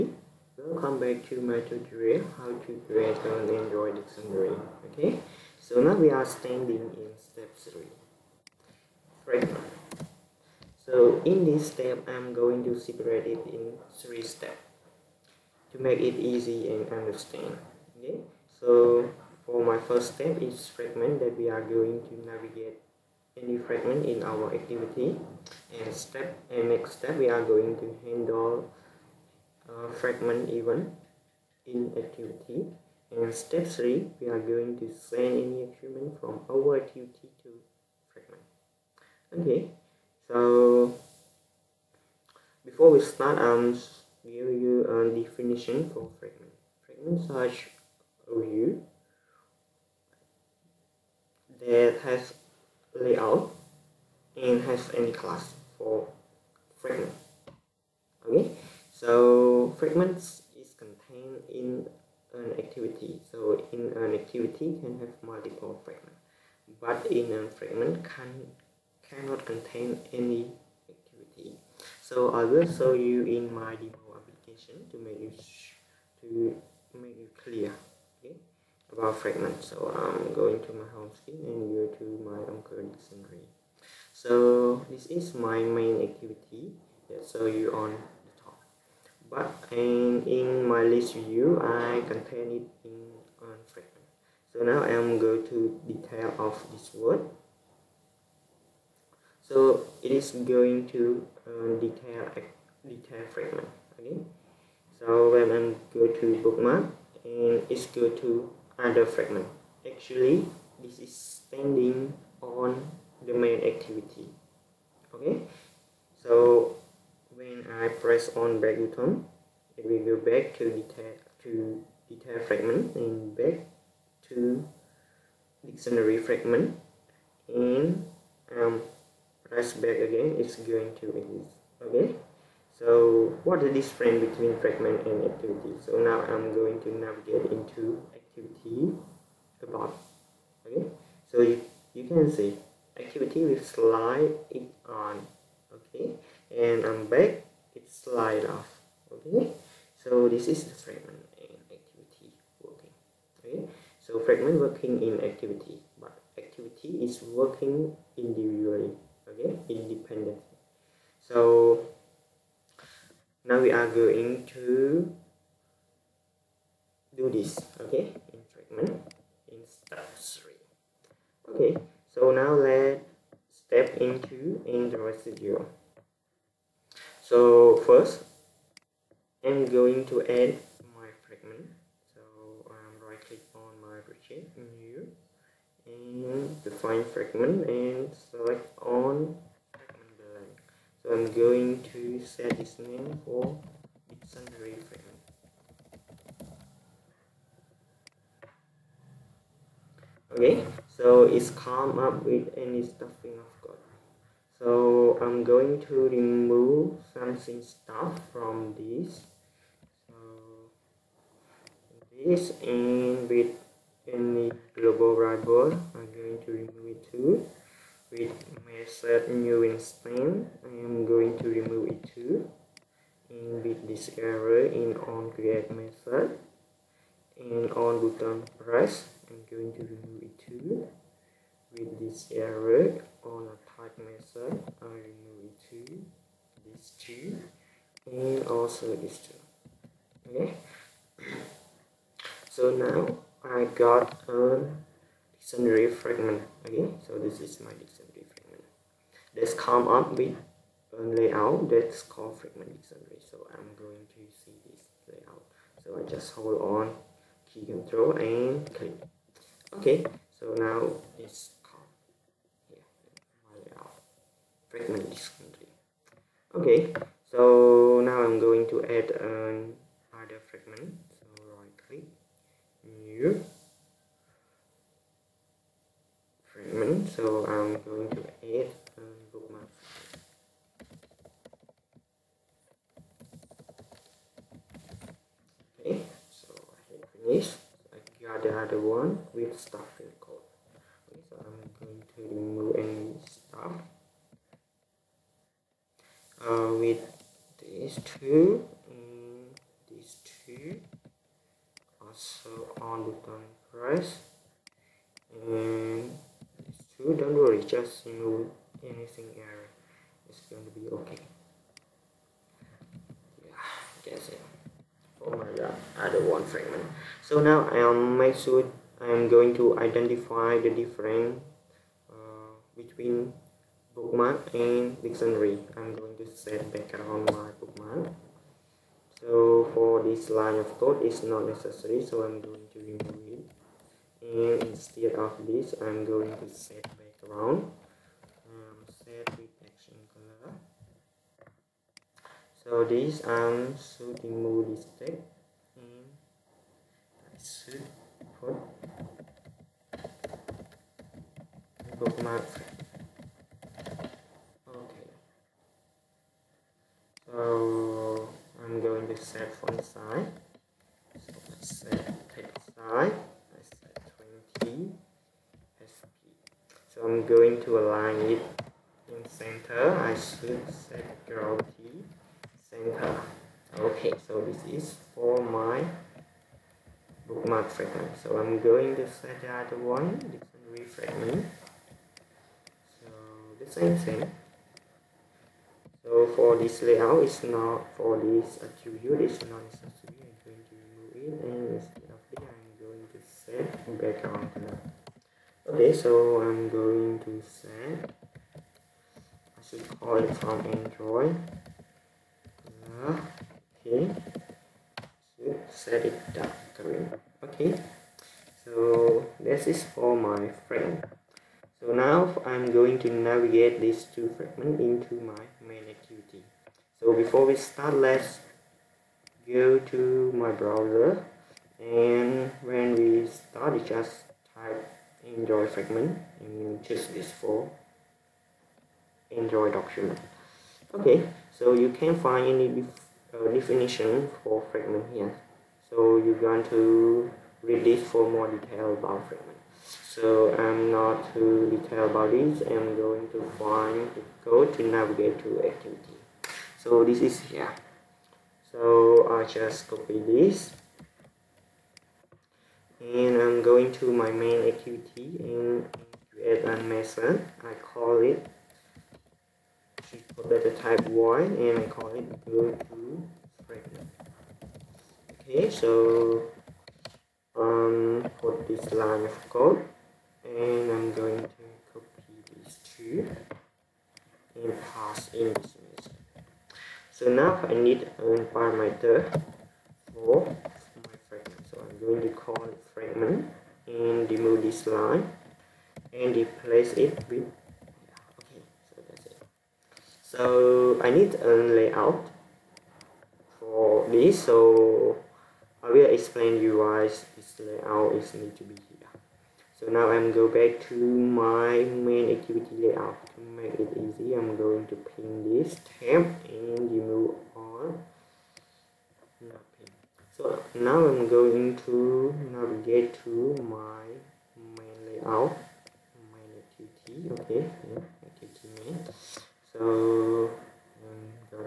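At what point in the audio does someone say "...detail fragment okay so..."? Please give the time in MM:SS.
01:42.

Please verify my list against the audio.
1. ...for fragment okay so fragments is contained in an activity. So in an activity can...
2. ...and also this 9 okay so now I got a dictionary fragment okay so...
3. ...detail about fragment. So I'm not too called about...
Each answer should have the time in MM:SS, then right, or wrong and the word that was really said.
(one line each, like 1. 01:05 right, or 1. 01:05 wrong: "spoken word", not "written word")
1. 00:55 right
2. 03:58 wrong: "2", not "9"
3. 07:18 wrong: "detailed", not "called".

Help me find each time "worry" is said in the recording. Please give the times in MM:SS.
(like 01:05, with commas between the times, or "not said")
05:07.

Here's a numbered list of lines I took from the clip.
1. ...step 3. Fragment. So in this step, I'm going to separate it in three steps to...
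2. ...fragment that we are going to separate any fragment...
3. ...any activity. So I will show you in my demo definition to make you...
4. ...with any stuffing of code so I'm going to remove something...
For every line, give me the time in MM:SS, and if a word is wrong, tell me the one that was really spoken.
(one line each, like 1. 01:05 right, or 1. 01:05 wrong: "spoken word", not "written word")
1. 00:07 right
2. 00:20 wrong: "navigate", not "separate"
3. 01:10 wrong: "application", not "definition"
4. 03:22 right.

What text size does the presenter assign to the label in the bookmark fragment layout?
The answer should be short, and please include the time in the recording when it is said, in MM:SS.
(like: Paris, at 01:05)
20 sp, at 06:04.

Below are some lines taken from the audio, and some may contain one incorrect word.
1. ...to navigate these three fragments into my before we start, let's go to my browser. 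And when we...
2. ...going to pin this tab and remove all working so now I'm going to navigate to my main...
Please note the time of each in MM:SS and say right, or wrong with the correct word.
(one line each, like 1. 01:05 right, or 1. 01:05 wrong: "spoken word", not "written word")
1. 06:52 wrong: "two", not "three"
2. 08:24 wrong: "nothing", not "working".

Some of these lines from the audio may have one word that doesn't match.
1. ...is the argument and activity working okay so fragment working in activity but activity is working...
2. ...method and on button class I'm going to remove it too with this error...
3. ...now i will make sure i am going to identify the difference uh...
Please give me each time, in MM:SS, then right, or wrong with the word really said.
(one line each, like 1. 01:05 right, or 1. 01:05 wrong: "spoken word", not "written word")
1. 02:30 wrong: "fragment", not "argument"
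2. 03:45 wrong: "press", not "class"
3. 05:17 right.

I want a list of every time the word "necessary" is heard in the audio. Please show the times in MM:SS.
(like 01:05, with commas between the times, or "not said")
05:31, 06:29.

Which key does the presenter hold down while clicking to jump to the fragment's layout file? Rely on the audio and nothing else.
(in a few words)
Control.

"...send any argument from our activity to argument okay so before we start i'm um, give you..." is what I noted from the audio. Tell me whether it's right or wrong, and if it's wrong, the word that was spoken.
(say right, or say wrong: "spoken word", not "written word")
wrong: "fragment", not "argument".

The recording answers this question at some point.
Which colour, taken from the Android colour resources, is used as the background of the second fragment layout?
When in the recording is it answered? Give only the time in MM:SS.
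06:46.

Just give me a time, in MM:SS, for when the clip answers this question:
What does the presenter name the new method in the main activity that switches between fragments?
07:42.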